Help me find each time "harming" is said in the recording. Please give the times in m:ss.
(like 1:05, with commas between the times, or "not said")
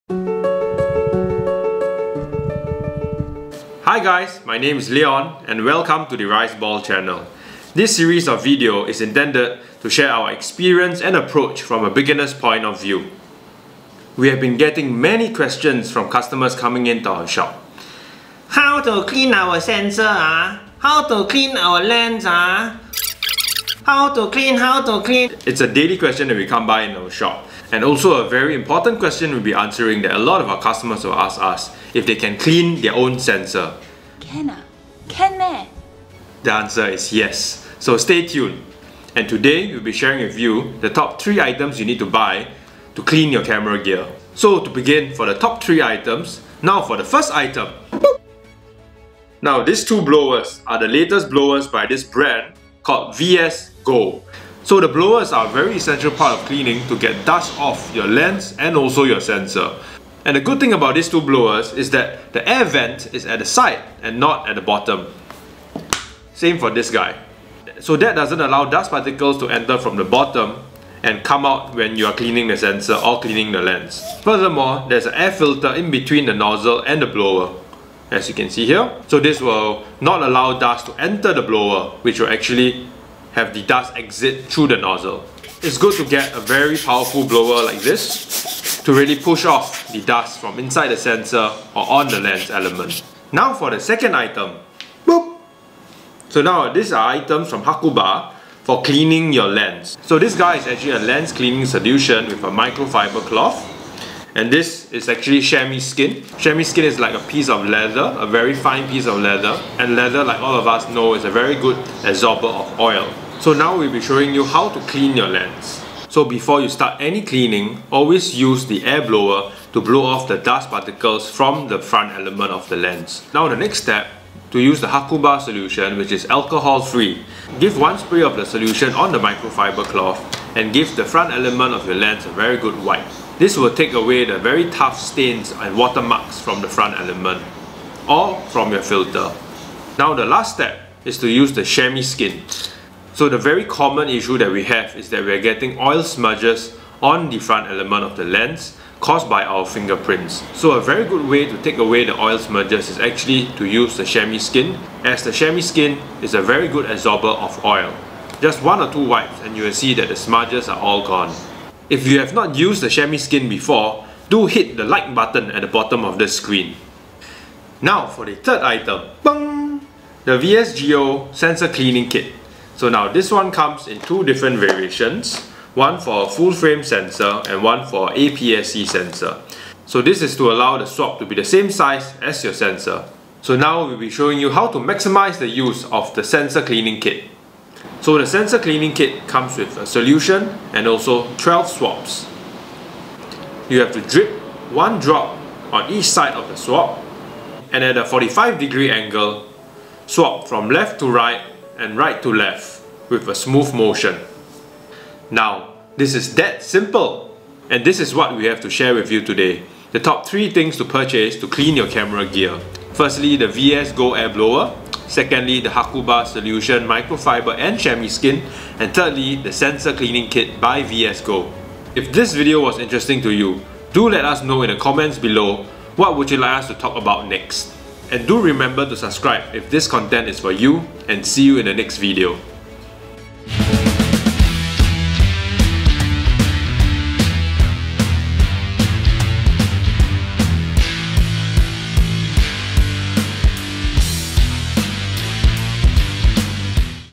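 not said.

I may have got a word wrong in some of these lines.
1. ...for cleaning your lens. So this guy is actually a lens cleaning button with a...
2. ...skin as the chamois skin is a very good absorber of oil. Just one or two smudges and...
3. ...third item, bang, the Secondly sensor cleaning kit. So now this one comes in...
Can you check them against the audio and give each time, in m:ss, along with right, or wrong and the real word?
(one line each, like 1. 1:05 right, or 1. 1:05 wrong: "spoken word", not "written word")
1. 1:38 wrong: "solution", not "button"
2. 2:34 wrong: "wipes", not "smudges"
3. 2:48 wrong: "VSGO", not "Secondly".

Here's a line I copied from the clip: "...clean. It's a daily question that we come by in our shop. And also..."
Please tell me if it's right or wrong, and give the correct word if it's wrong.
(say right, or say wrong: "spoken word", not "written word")
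right.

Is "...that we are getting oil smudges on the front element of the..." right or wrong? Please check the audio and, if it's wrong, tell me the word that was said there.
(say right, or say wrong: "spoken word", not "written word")
right.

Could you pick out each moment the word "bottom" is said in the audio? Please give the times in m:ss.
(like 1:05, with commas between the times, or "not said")
1:04, 1:10, 2:45.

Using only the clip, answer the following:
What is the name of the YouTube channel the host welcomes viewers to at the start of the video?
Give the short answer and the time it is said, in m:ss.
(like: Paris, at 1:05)
Riceball, at 0:06.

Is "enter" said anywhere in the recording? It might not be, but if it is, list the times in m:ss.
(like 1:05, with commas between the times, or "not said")
1:09, 1:21.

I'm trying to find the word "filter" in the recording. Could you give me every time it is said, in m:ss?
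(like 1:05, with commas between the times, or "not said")
1:15, 2:18.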